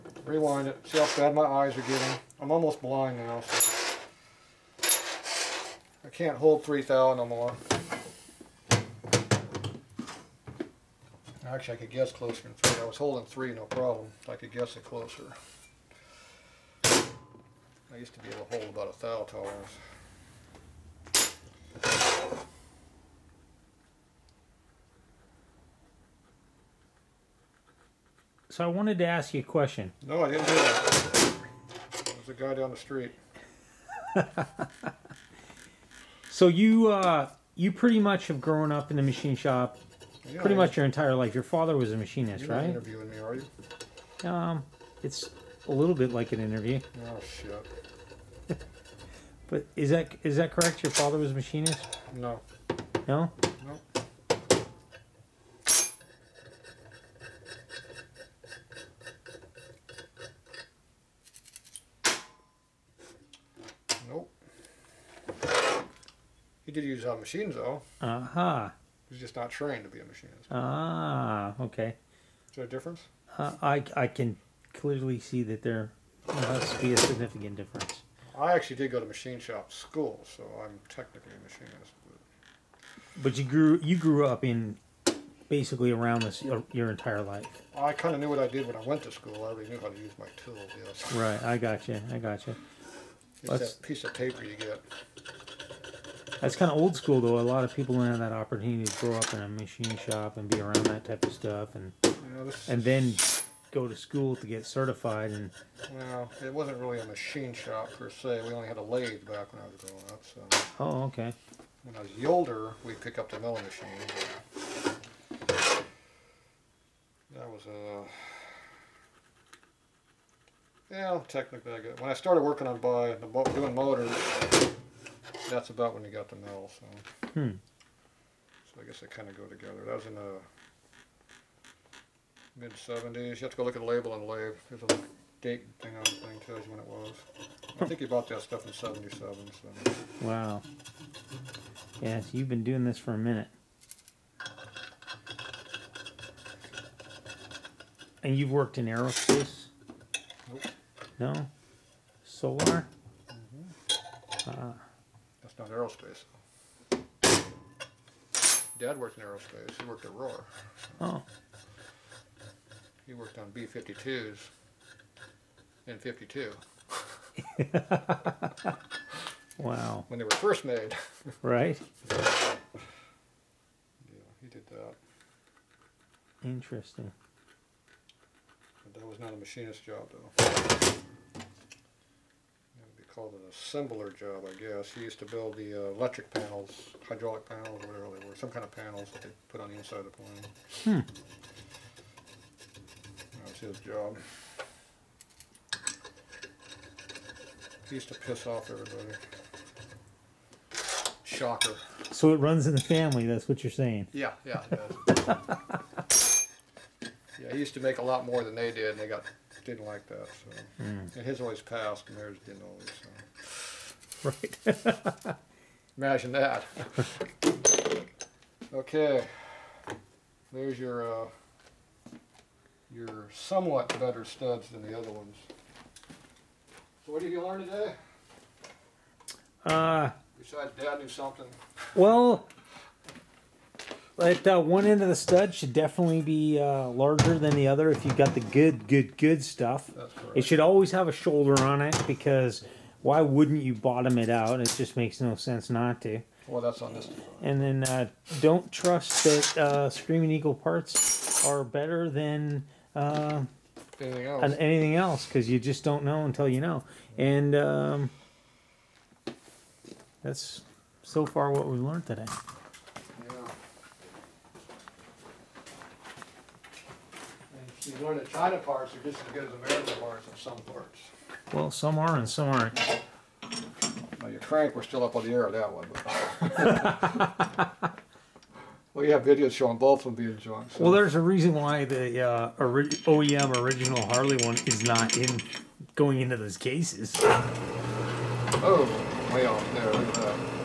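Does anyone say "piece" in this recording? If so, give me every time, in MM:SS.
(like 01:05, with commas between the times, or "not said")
01:33.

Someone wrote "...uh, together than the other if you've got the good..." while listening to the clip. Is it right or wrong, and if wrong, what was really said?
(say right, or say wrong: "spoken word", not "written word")
wrong: "larger", not "together".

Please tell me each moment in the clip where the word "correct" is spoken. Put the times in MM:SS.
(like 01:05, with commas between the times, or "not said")
00:50.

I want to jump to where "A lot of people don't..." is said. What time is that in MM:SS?
01:37.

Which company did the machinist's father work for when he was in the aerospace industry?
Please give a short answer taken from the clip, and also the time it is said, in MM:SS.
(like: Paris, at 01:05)
Rohr, at 02:40.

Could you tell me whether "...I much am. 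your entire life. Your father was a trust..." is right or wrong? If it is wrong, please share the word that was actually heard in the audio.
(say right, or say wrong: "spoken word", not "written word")
wrong: "machinist", not "trust".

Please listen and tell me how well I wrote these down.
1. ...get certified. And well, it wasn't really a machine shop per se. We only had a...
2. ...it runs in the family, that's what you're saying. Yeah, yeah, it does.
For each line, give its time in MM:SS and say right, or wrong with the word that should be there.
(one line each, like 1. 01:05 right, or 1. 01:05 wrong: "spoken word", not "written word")
1. 01:44 right
2. 03:22 right.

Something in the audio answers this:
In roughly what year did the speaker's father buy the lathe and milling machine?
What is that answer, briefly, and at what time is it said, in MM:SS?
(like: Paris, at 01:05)
1977, at 02:18.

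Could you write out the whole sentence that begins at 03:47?
So what did you learn today?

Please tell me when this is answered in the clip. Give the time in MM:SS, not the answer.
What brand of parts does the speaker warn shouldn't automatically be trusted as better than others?
04:09.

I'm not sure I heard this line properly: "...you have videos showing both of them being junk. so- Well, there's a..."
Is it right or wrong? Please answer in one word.
right.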